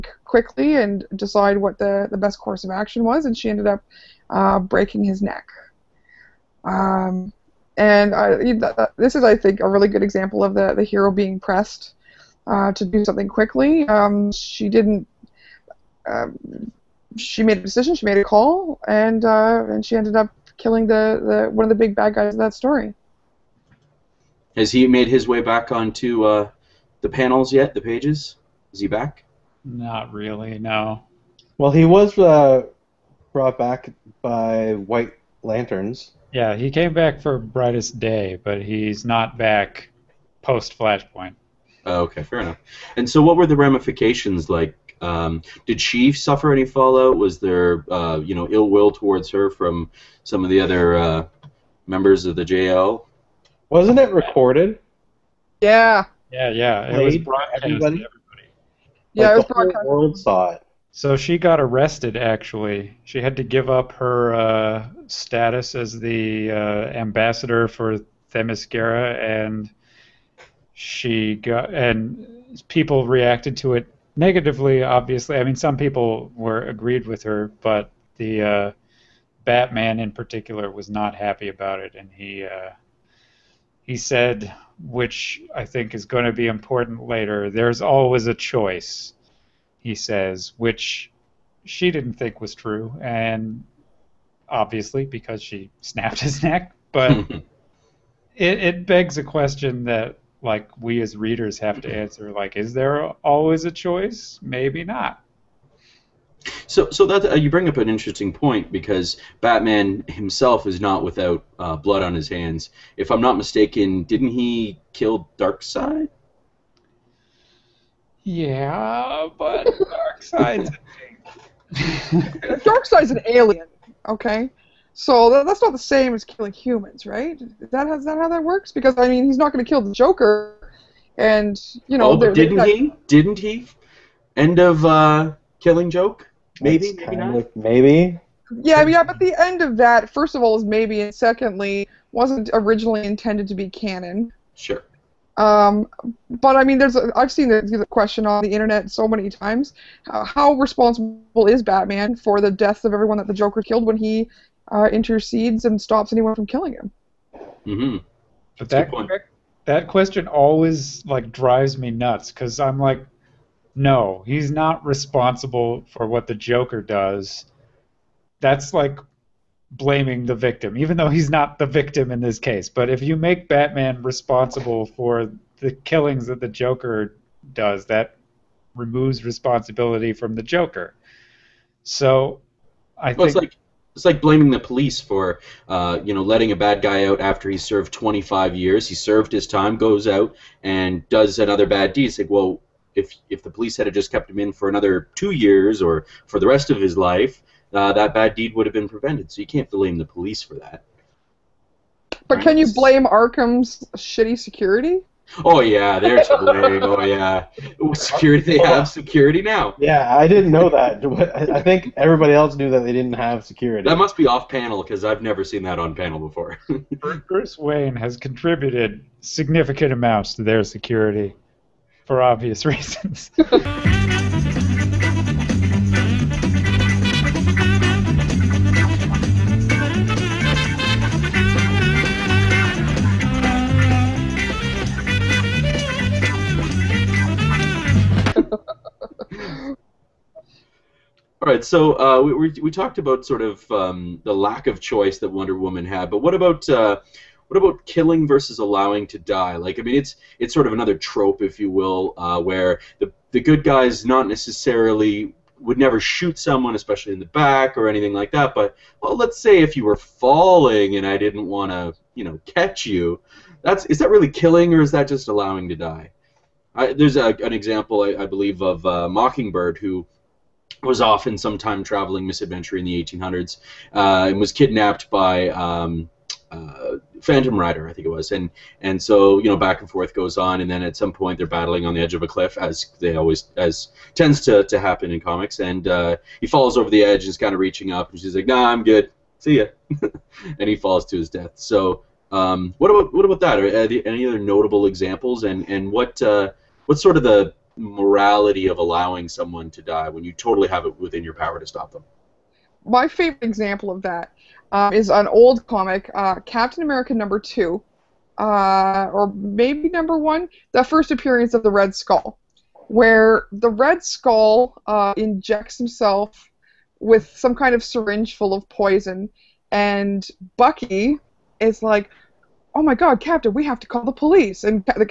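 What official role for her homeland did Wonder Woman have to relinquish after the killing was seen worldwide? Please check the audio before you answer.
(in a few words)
ambassador for Themyscira.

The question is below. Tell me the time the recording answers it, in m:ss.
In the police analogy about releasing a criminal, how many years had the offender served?
3:07.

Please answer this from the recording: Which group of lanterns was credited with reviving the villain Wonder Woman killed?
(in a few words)
White Lanterns.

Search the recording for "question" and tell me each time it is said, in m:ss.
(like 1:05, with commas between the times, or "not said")
1:39, 2:27, 2:39.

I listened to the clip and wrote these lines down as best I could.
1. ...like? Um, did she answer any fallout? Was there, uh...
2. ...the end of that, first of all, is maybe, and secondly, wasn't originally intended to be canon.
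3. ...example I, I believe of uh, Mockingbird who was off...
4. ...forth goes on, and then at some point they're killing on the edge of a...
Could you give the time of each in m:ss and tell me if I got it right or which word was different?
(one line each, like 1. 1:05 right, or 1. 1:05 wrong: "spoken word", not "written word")
1. 0:44 wrong: "suffer", not "answer"
2. 2:19 right
3. 4:27 right
4. 4:39 wrong: "battling", not "killing".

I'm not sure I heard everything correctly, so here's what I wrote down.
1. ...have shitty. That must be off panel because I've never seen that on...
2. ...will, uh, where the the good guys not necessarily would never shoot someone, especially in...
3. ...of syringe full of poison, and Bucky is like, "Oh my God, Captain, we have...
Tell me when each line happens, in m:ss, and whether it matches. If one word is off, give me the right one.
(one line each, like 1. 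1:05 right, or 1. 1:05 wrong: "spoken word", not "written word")
1. 3:33 wrong: "security", not "shitty"
2. 4:11 right
3. 5:17 right.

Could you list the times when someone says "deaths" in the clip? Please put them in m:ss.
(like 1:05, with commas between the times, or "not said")
2:32, 4:51.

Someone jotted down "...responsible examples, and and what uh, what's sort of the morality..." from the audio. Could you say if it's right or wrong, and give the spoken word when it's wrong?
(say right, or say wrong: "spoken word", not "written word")
wrong: "notable", not "responsible".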